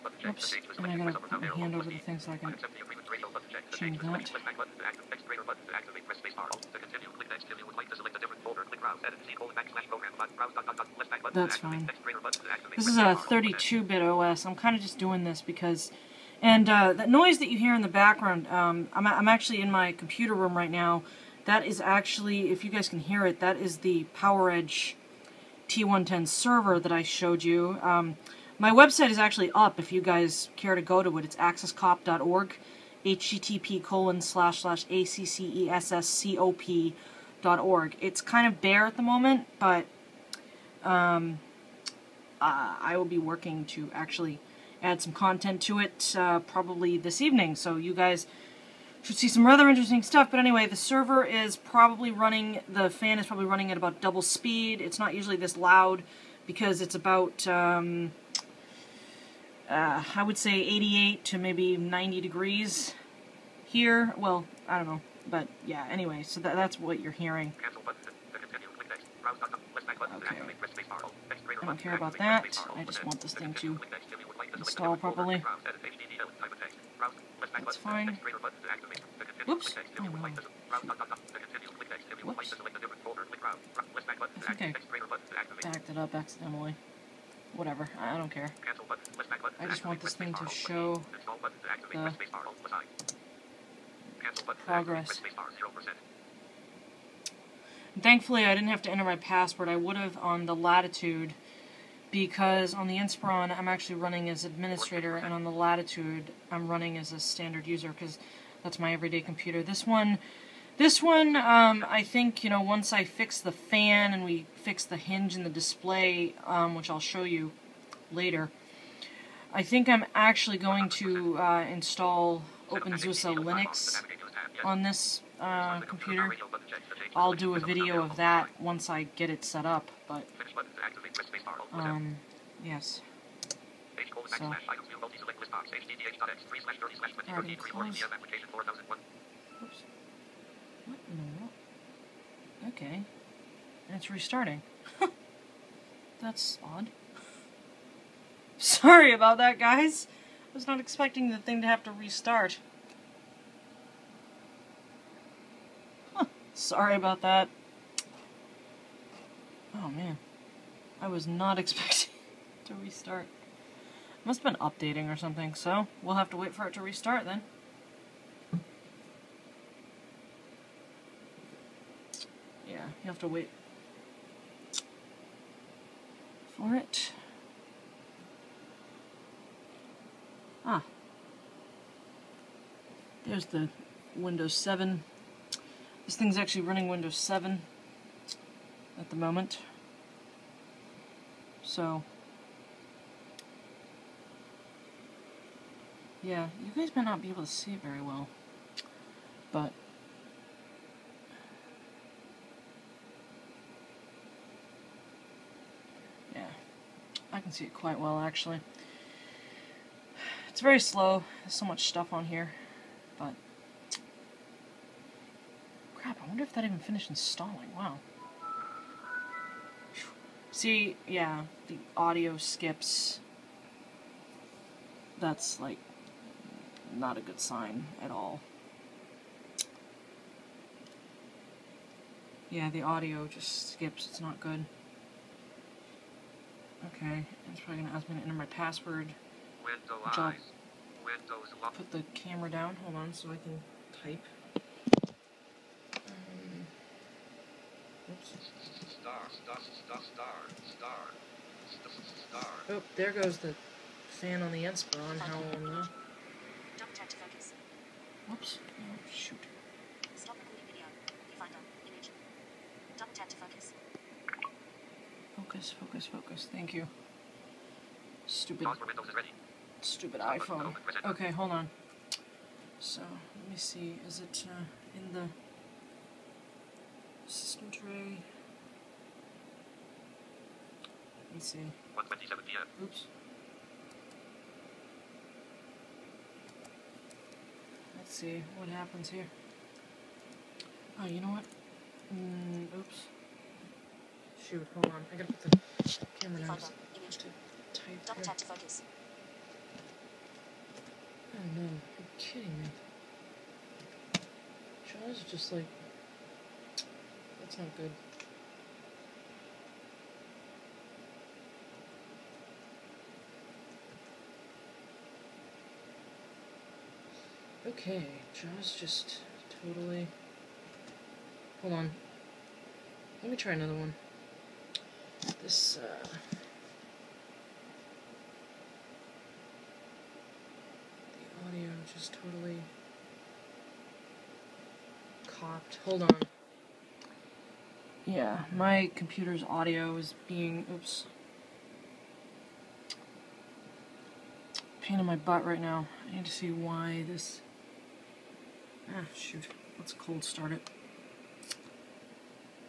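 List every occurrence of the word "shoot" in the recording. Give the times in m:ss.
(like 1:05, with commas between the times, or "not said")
4:19, 4:54, 5:49.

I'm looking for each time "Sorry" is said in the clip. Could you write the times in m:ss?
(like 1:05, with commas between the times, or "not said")
2:28, 2:36.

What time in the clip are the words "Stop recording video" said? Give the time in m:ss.
4:20.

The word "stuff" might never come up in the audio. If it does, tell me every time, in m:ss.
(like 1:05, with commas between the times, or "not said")
0:50, 3:31.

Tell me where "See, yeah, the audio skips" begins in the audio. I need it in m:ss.
3:40.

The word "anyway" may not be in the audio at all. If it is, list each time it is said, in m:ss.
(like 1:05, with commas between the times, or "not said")
0:50, 1:05.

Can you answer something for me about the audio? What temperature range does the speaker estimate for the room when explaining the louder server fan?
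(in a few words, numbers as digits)
88 to 90 degrees.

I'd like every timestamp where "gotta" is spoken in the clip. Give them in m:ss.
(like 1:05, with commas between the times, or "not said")
0:00, 4:55.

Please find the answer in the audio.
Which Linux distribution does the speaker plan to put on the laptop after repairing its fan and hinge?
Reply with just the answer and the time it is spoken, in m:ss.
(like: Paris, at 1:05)
OpenSUSE, at 2:02.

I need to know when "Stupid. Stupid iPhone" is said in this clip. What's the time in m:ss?
4:28.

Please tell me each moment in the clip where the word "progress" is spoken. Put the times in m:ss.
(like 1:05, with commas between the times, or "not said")
1:34.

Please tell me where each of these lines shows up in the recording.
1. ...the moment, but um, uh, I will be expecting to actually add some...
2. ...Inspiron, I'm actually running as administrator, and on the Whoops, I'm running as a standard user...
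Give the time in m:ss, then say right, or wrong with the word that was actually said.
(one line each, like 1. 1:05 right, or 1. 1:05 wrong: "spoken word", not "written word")
1. 0:38 wrong: "working", not "expecting"
2. 1:42 wrong: "Latitude", not "Whoops".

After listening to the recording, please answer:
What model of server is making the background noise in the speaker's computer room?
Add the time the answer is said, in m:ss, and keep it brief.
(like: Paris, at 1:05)
PowerEdge T110, at 0:24.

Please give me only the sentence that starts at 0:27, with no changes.
Um, my website is actually up if you guys care to go to it.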